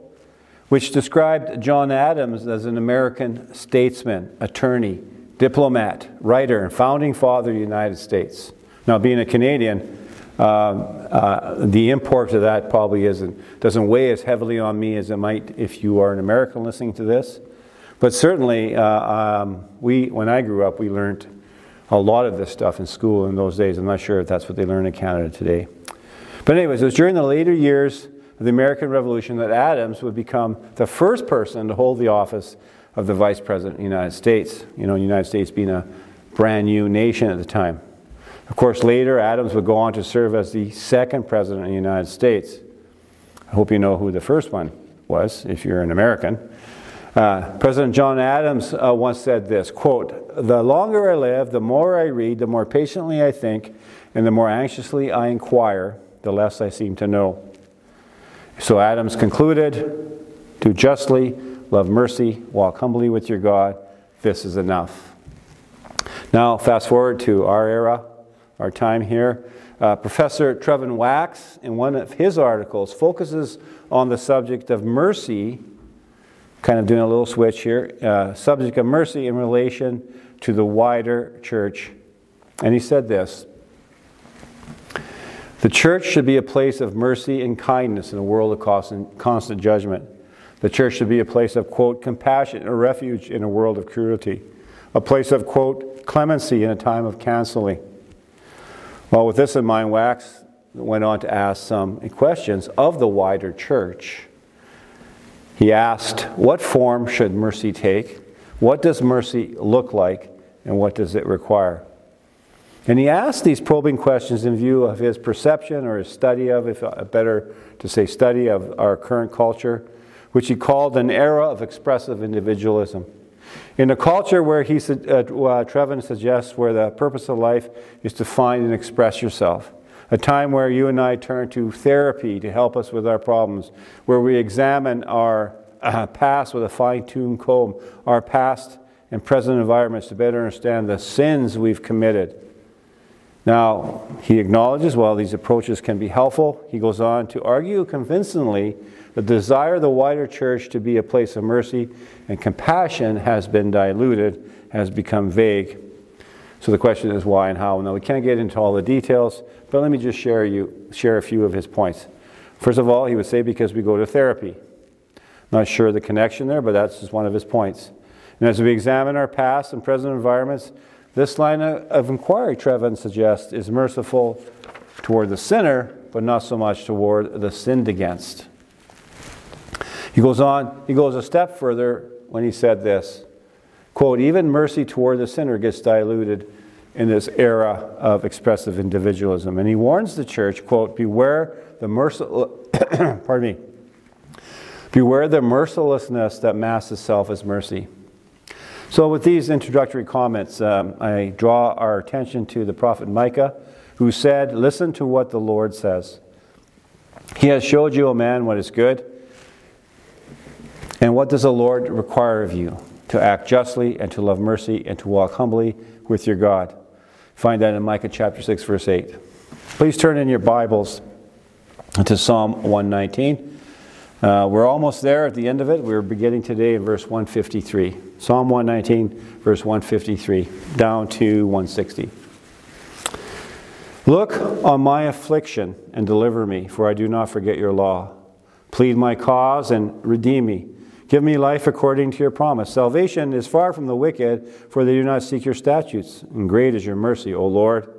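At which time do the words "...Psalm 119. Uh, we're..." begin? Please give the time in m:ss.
3:42.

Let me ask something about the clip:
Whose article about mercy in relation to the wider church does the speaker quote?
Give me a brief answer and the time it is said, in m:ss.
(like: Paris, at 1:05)
Trevin Wax, at 1:10.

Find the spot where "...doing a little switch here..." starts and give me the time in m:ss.
1:16.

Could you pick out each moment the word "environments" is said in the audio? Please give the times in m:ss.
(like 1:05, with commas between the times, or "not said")
2:19, 2:50.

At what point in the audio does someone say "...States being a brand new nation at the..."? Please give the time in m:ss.
0:35.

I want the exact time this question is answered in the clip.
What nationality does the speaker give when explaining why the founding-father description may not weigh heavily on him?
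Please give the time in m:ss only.
0:09.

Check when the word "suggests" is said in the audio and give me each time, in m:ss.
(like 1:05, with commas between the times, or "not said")
2:06, 2:52.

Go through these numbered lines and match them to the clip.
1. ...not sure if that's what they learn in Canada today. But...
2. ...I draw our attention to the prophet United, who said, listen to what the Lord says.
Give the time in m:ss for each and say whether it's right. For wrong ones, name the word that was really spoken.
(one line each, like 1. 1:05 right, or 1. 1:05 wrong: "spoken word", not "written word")
1. 0:23 right
2. 3:21 wrong: "Micah", not "United".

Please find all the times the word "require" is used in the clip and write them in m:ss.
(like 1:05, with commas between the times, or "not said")
1:51, 3:31.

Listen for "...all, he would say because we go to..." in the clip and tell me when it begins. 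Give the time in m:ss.
2:42.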